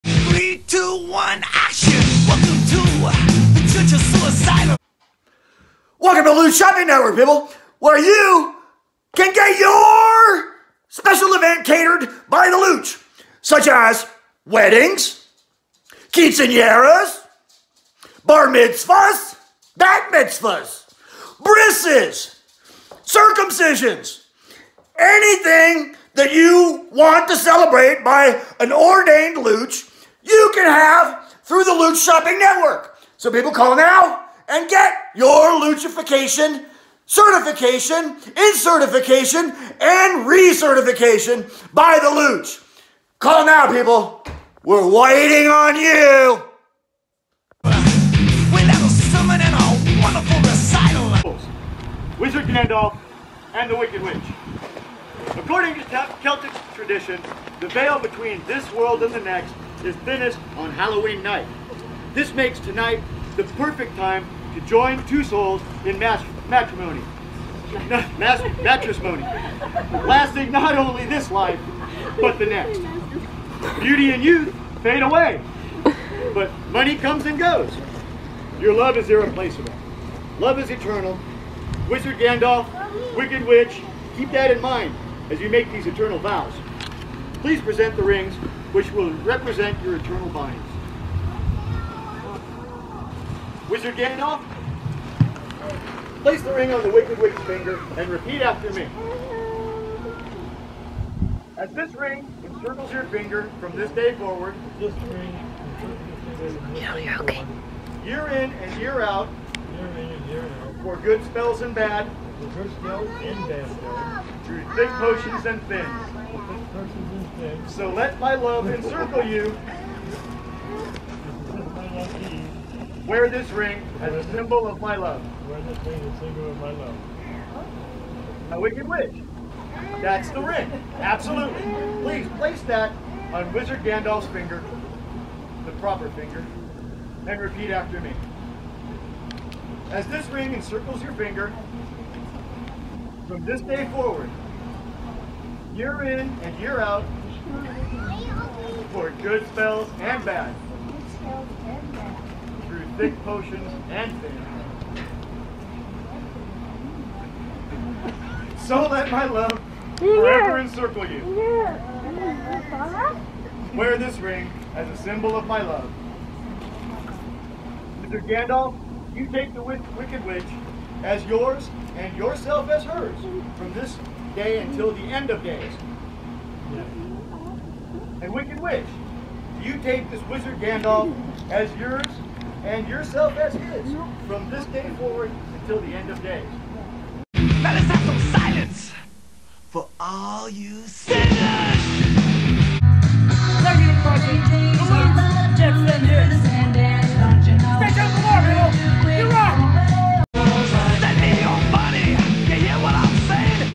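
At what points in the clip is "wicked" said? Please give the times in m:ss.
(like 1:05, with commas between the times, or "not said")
0:53, 1:23, 1:36, 2:08, 2:49, 2:58.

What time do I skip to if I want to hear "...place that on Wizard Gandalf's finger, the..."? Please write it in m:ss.
2:12.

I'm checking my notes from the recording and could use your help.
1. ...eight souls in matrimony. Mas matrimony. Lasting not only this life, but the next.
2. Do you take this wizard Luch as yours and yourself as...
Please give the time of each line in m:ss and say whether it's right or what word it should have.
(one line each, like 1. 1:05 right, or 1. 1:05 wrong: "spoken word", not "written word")
1. 1:05 wrong: "two", not "eight"
2. 2:59 wrong: "Gandalf", not "Luch".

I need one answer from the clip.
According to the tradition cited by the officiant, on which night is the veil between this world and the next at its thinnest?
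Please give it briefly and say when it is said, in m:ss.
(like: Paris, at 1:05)
Halloween night, at 1:00.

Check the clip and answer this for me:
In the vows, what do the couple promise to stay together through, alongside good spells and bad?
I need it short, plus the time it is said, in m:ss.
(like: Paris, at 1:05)
thick potions and thins, at 1:54.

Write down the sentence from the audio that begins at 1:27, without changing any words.
Please present the rings which will represent your eternal binds.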